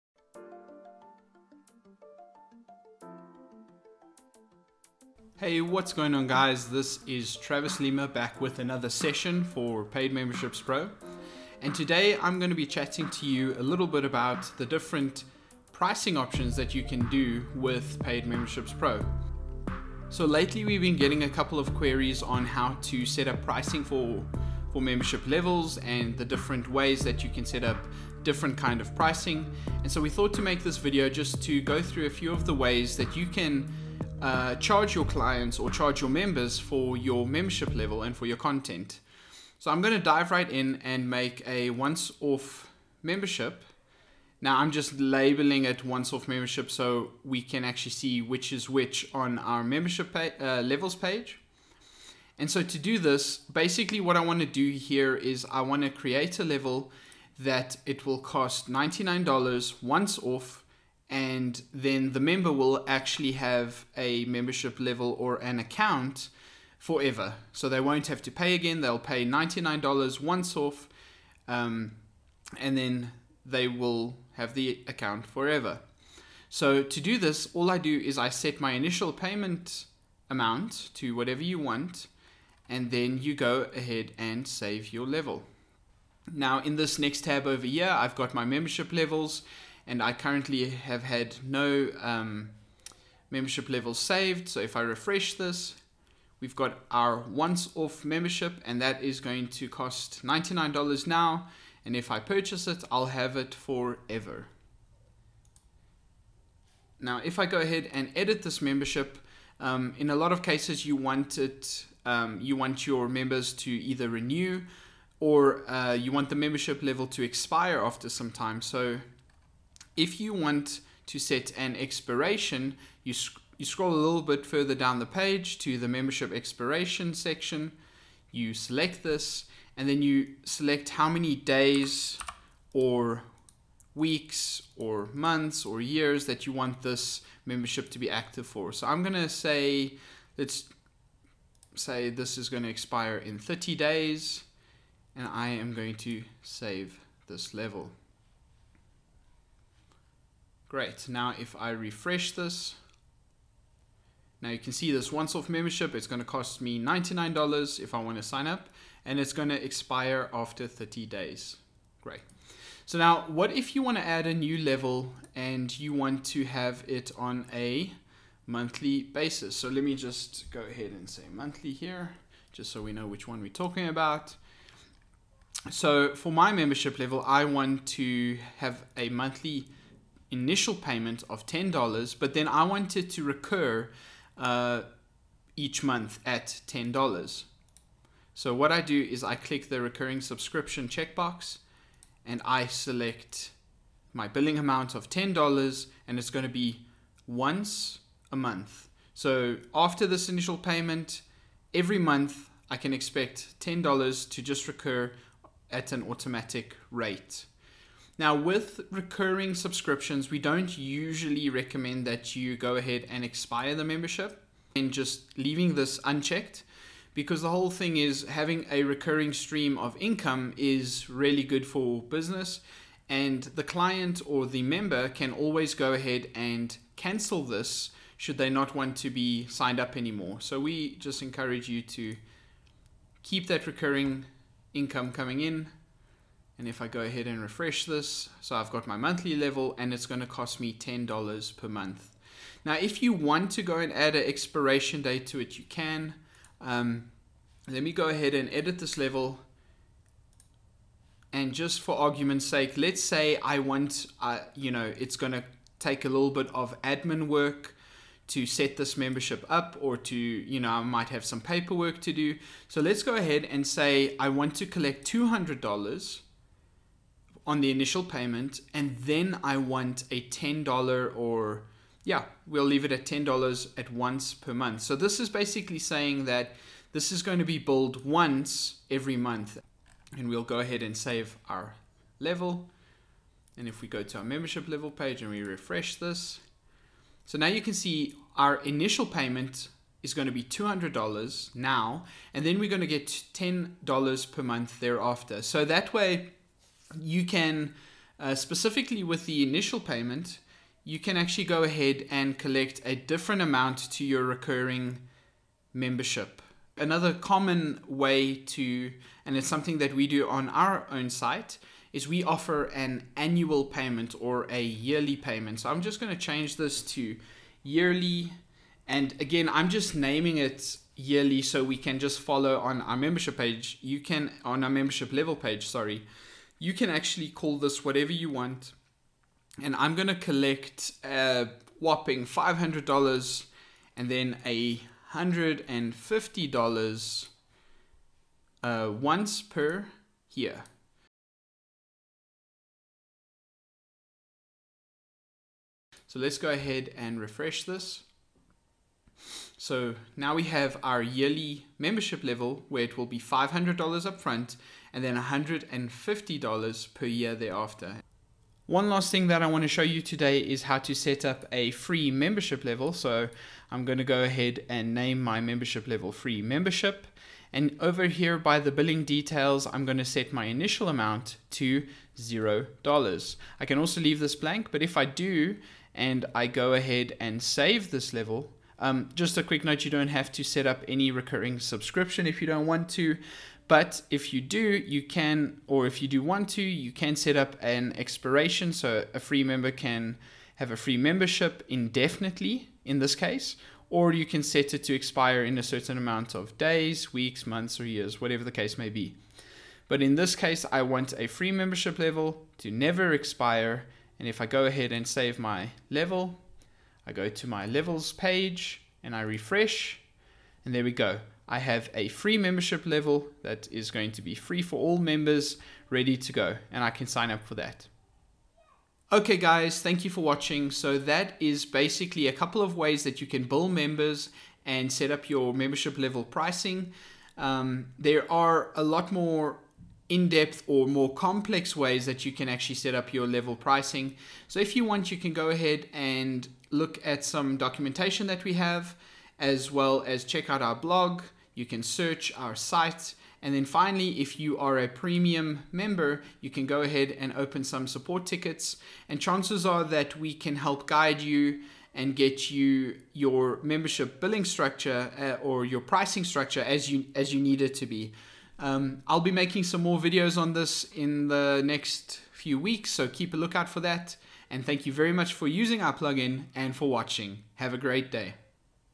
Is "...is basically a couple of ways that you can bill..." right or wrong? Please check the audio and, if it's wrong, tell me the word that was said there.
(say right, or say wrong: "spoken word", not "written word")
right.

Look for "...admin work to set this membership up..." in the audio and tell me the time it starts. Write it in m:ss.
4:16.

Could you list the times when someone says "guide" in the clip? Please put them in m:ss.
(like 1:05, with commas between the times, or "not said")
7:30.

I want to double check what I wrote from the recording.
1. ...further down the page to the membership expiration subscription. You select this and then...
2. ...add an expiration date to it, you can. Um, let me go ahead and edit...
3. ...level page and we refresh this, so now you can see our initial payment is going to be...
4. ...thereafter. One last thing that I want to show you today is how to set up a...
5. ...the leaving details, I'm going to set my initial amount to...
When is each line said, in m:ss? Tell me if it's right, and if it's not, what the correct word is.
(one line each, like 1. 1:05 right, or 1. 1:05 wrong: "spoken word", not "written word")
1. 2:04 wrong: "section", not "subscription"
2. 4:03 right
3. 4:44 right
4. 5:57 right
5. 6:08 wrong: "billing", not "leaving".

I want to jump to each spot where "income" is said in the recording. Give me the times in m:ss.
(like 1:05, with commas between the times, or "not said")
3:39, 3:54.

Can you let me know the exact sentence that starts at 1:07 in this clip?
So they won't have to pay again.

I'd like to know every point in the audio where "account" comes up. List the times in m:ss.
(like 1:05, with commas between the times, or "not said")
1:05, 1:14.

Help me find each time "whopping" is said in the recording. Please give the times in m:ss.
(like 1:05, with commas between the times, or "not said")
5:31.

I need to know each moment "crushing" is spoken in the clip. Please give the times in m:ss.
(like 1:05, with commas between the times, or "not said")
not said.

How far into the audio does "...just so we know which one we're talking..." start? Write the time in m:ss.
2:52.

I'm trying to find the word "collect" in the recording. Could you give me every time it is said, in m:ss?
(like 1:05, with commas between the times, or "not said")
4:24, 5:02, 5:30.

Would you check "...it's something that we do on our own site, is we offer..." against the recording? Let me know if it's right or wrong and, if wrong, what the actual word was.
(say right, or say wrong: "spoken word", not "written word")
right.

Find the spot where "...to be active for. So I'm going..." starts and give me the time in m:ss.
2:17.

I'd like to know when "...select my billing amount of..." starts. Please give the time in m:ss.
3:12.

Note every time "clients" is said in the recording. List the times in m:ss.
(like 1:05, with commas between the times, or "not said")
0:35, 3:43.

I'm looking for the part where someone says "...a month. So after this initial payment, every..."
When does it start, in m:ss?
3:18.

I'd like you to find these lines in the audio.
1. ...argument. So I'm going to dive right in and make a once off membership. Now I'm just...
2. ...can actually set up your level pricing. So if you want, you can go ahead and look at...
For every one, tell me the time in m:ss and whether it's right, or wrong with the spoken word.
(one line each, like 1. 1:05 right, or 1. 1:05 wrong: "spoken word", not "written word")
1. 0:38 wrong: "content", not "argument"
2. 7:12 right.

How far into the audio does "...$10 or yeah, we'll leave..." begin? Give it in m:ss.
4:30.